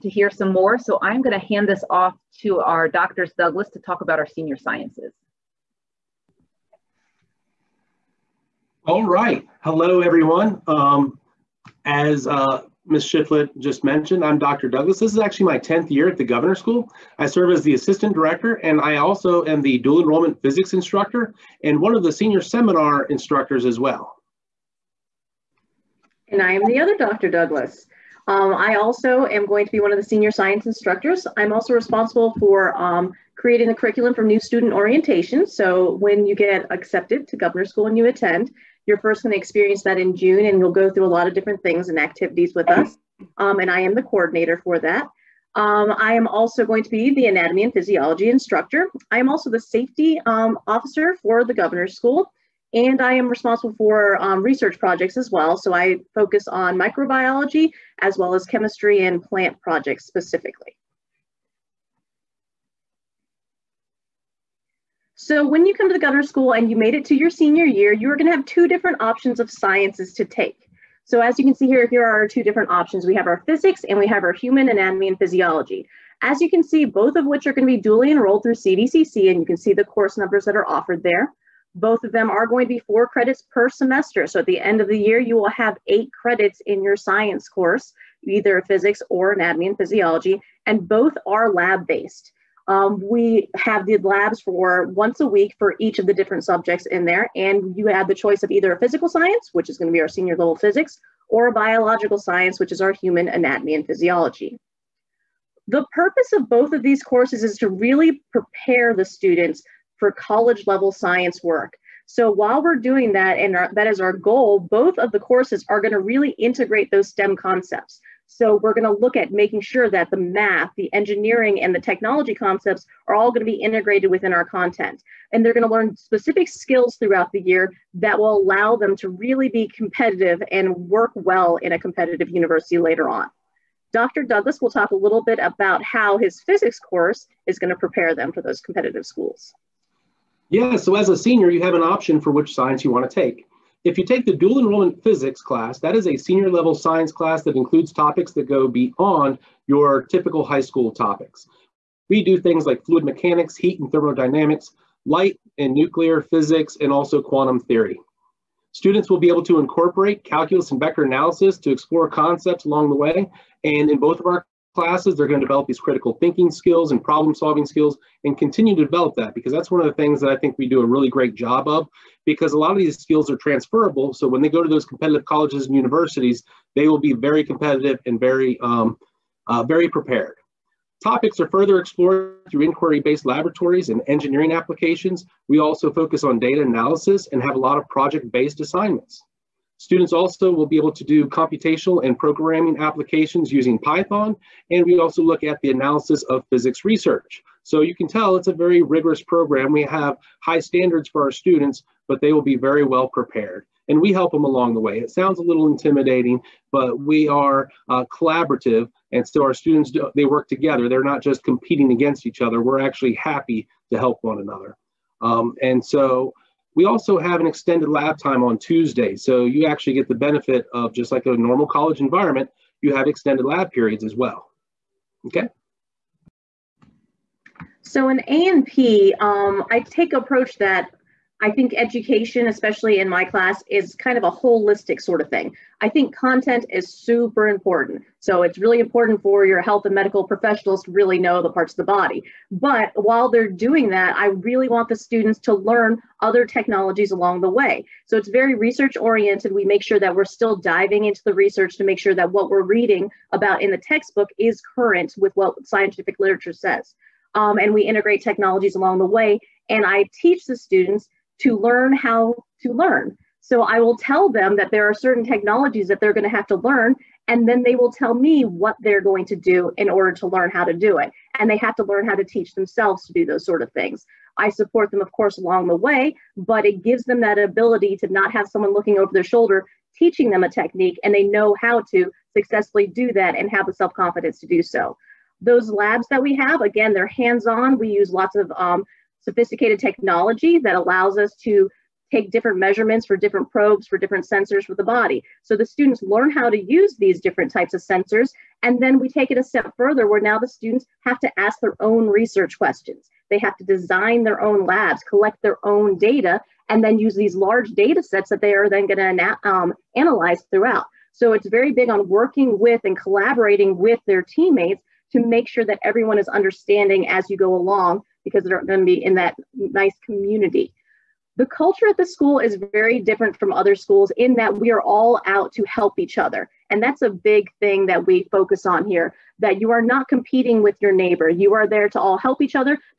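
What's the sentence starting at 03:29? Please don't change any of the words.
And so our students, do, they work together.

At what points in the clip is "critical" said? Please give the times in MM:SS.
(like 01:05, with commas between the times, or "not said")
02:45.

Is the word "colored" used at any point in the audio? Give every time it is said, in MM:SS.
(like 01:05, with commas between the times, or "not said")
not said.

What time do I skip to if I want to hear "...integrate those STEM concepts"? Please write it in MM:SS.
01:56.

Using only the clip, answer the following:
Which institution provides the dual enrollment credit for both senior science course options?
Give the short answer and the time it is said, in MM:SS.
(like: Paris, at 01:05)
CVCC, at 01:18.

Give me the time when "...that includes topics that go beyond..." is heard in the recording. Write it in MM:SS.
02:27.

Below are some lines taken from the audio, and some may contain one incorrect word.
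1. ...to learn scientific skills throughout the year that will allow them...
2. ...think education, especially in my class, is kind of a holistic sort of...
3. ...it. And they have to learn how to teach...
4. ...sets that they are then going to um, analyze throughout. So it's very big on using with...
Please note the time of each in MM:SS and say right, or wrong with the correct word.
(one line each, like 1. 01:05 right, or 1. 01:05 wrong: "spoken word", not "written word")
1. 02:05 wrong: "specific", not "scientific"
2. 03:51 right
3. 04:30 right
4. 05:08 wrong: "working", not "using".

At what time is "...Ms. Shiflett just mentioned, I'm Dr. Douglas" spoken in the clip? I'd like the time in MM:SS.
00:12.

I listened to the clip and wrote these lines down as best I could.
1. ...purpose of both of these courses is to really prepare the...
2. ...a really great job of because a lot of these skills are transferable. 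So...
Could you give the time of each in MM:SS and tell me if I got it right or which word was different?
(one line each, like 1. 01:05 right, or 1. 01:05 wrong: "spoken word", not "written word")
1. 01:45 right
2. 02:50 right.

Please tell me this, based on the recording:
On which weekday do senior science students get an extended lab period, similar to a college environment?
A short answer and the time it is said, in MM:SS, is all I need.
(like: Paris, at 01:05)
Tuesday, at 03:38.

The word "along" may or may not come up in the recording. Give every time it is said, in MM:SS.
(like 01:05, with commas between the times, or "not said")
02:42, 03:24, 04:07, 04:18, 04:35, 05:17.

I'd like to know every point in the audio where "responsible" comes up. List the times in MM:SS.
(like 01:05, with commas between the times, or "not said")
00:31, 00:53.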